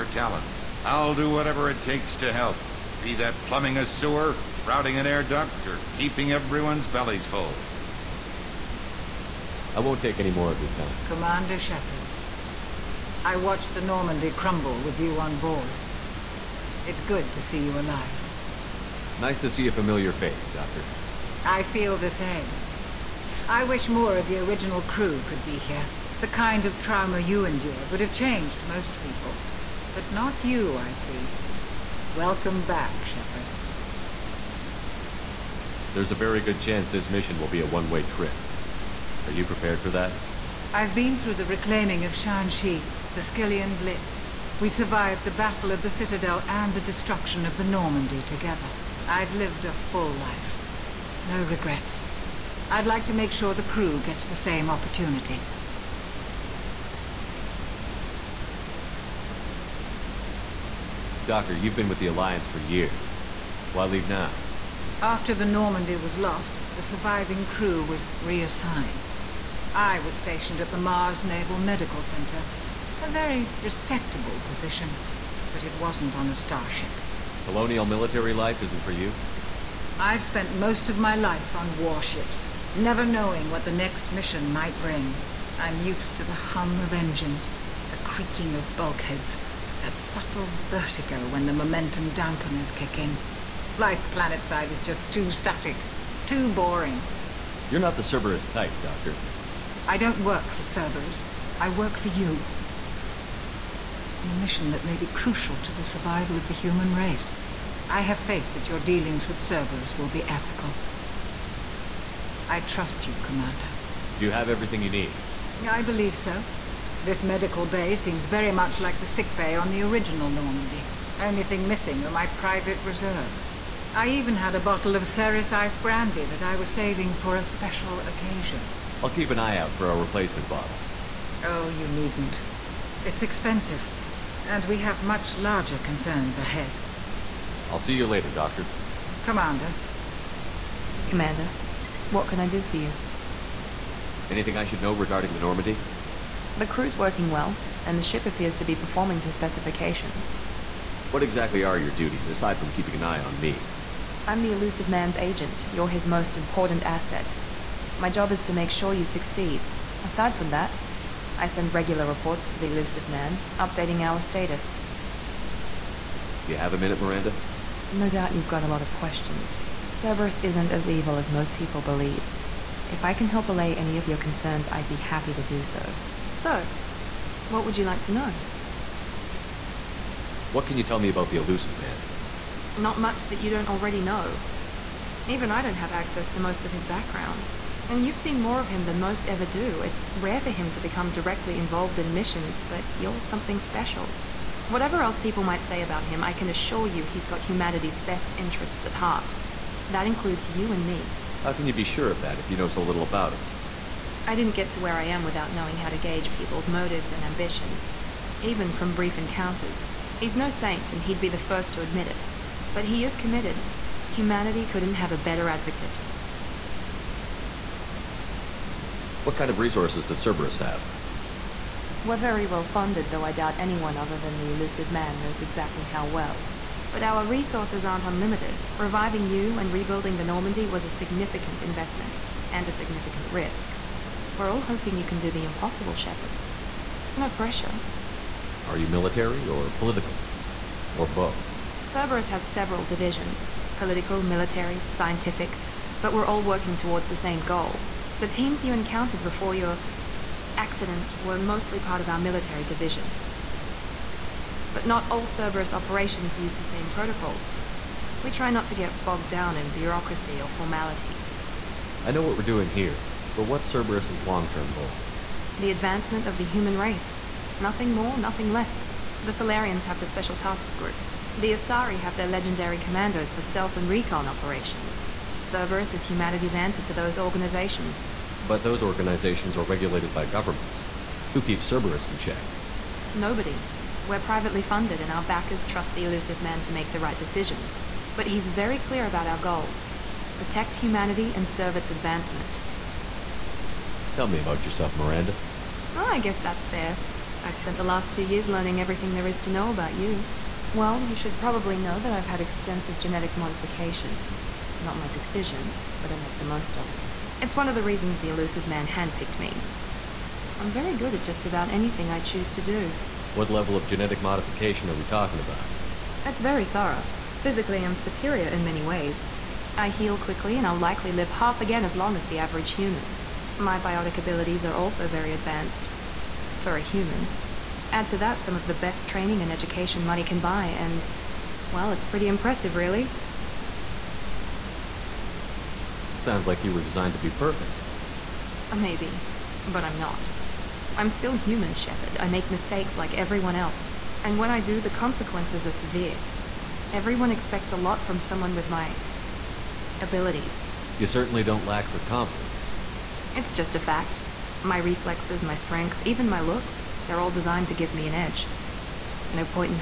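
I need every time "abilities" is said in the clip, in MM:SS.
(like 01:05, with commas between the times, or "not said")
05:24, 05:50.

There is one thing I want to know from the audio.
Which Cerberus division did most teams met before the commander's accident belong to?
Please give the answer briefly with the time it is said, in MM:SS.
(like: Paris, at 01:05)
military division, at 04:12.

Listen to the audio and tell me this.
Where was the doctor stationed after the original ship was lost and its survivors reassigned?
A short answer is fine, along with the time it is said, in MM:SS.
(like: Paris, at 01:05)
Mars Naval Medical Center, at 01:10.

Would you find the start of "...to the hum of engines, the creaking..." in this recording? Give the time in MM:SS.
01:26.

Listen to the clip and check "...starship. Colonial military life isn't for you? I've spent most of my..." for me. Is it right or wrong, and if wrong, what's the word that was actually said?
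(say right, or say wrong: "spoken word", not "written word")
right.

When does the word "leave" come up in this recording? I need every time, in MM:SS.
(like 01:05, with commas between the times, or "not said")
01:03.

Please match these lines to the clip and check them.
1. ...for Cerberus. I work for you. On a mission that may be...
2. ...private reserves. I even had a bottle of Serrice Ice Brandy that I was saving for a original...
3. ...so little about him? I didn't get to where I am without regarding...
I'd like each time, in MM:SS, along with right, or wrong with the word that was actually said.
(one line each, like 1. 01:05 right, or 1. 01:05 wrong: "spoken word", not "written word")
1. 01:40 right
2. 02:02 wrong: "special", not "original"
3. 03:22 wrong: "knowing", not "regarding".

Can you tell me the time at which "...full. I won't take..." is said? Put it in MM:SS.
00:07.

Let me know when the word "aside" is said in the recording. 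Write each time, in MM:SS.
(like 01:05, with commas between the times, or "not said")
02:32, 02:40.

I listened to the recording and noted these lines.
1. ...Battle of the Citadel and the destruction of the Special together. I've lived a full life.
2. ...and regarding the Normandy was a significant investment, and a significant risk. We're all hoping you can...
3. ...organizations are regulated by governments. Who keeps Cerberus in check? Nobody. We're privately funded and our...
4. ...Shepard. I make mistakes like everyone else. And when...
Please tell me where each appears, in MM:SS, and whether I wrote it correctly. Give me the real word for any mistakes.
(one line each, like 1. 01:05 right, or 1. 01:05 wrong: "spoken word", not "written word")
1. 00:45 wrong: "Normandy", not "Special"
2. 03:49 wrong: "rebuilding", not "regarding"
3. 04:38 right
4. 05:41 right.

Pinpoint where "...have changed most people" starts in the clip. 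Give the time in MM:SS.
00:28.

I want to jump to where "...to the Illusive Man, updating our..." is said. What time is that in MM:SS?
02:42.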